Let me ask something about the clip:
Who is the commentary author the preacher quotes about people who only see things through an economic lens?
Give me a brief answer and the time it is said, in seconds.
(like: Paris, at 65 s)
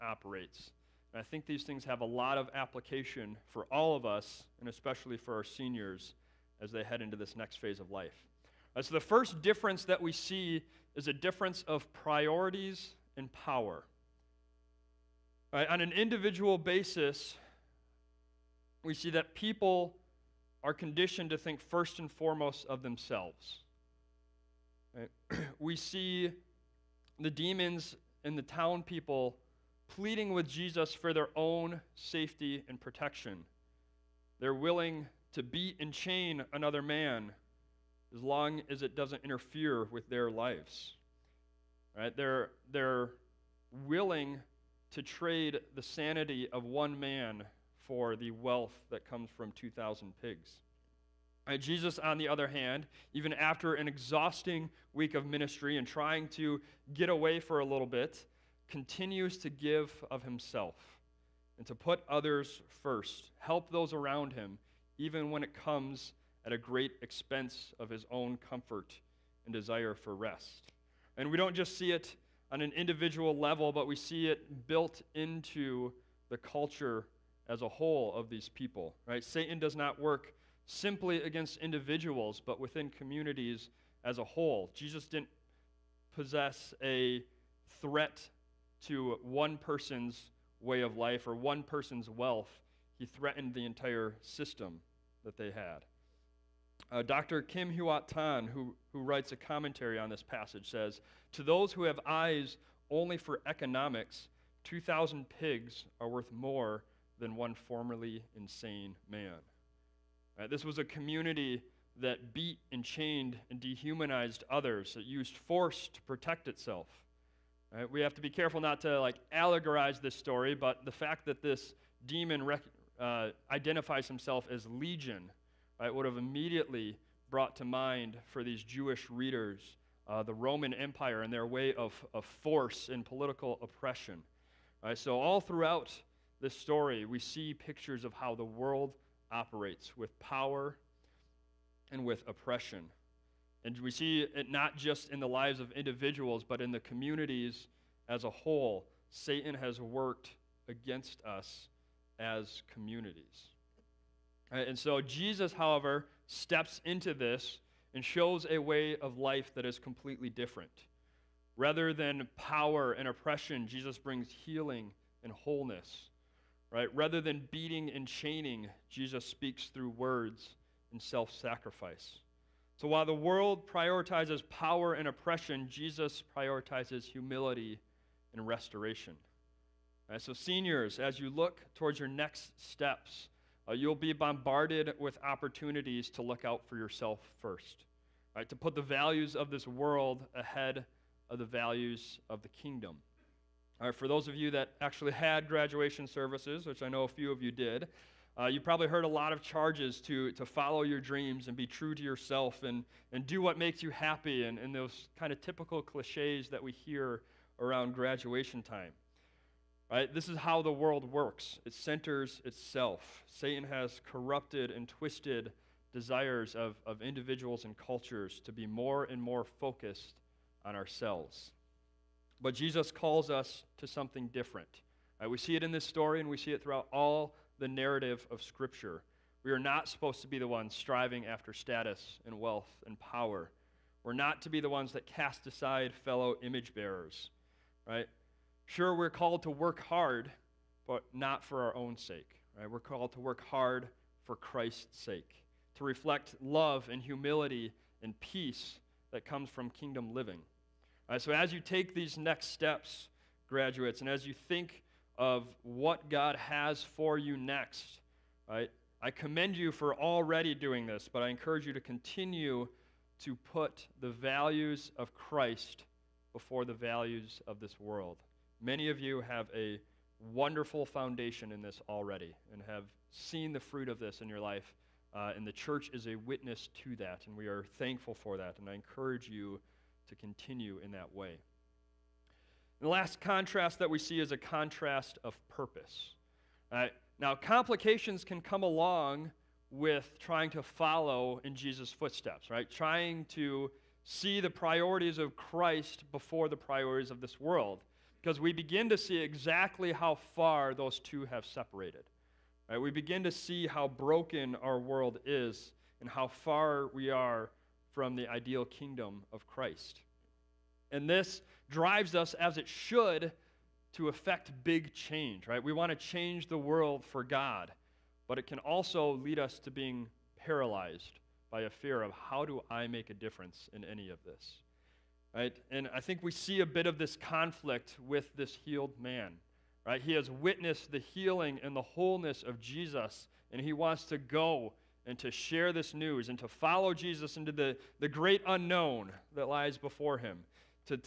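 Dr. Kim Huat Tan, at 97 s.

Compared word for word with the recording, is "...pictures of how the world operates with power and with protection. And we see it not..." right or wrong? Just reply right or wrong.
wrong.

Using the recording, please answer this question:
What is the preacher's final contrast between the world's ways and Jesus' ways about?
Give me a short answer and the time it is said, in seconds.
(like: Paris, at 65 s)
Purpose, at 285 s.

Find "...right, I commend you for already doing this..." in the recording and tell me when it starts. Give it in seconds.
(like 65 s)
258 s.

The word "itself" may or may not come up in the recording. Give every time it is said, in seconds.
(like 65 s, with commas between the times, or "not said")
116 s, 212 s.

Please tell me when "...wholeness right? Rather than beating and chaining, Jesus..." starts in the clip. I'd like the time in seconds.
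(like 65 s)
165 s.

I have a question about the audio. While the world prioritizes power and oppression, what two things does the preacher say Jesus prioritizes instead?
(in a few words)
Humility and restoration.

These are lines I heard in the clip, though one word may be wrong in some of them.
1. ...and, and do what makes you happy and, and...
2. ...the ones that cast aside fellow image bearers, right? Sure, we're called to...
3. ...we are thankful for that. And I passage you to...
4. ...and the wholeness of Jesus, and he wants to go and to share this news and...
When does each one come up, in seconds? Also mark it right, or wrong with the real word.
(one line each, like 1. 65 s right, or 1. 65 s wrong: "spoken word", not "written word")
1. 202 s right
2. 234 s right
3. 277 s wrong: "encourage", not "passage"
4. 331 s right.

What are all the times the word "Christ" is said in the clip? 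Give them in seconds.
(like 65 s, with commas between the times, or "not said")
244 s, 265 s, 295 s, 309 s.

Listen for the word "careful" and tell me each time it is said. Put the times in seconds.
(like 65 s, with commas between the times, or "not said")
118 s.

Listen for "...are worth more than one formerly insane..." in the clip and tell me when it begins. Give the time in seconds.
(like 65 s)
105 s.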